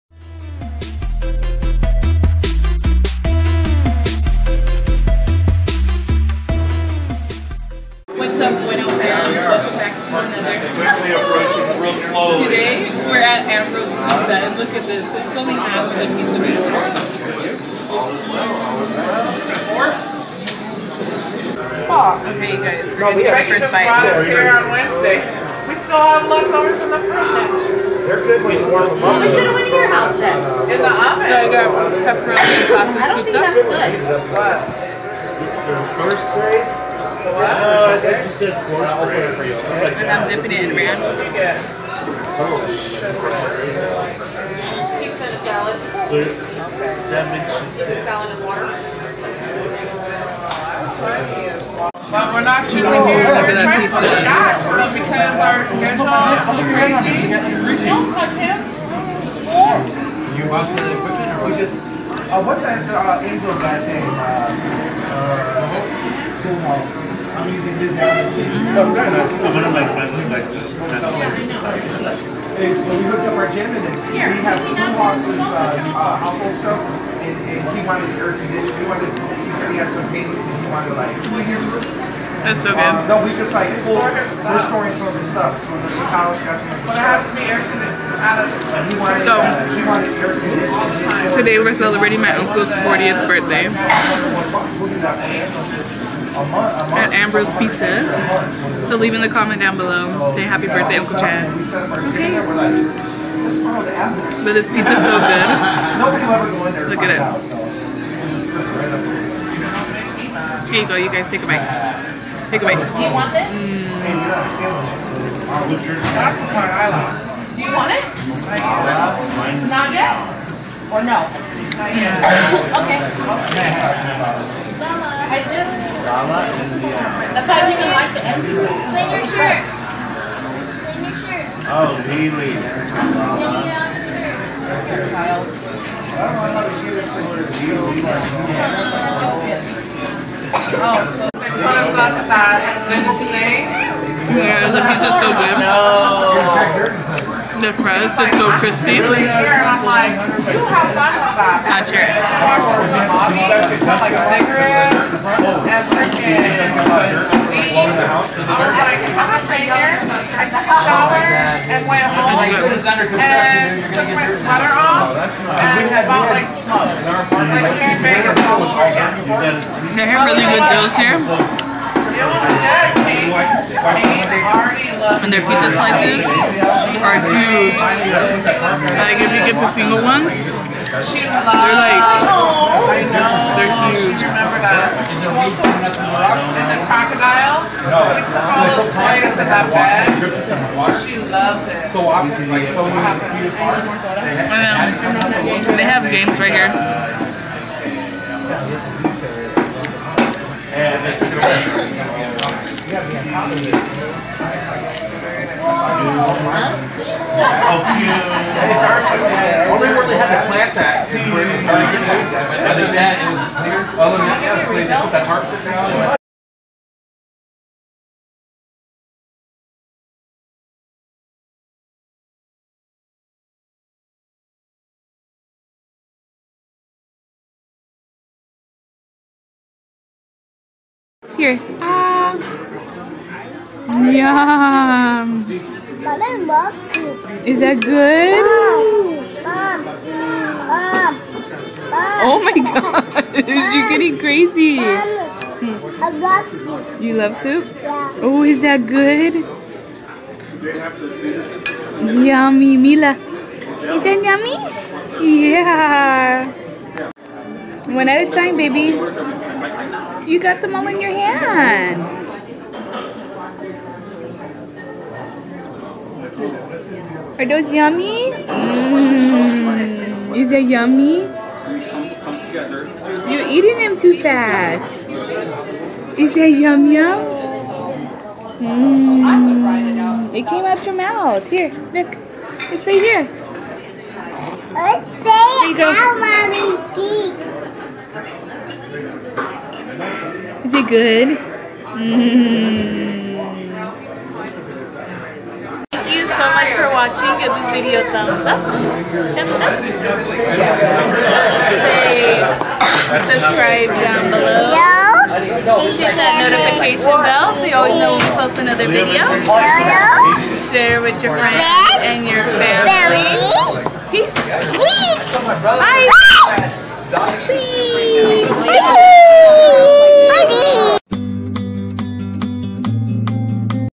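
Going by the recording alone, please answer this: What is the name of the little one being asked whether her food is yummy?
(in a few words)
Mila.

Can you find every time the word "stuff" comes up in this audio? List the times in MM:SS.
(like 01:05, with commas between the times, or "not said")
01:16, 01:25.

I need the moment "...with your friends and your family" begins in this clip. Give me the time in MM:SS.
05:11.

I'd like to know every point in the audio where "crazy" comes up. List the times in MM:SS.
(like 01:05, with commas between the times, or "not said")
00:56, 04:04.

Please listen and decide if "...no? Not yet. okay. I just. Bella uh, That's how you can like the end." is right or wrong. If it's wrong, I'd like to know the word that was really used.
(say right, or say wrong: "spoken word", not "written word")
right.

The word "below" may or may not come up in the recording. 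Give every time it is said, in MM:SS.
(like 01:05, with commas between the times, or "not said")
01:39, 05:04.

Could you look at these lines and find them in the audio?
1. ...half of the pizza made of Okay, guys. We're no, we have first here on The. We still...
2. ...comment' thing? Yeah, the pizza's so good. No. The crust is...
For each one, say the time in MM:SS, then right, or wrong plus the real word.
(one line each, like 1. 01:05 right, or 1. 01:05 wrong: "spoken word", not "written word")
1. 00:15 wrong: "Wednesday", not "The"
2. 02:22 wrong: "students", not "comment".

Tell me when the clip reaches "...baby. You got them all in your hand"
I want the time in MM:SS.
04:18.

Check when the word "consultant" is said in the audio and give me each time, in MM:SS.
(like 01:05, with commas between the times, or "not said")
not said.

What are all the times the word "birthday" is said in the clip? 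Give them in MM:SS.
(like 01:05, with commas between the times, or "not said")
01:33, 01:40.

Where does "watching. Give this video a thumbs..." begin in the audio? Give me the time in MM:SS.
04:57.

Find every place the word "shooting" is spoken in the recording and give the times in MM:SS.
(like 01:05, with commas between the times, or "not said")
00:52.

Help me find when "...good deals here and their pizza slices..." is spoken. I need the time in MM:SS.
02:50.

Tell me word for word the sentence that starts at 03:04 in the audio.
And The crocodile, we took all those toys in that bag.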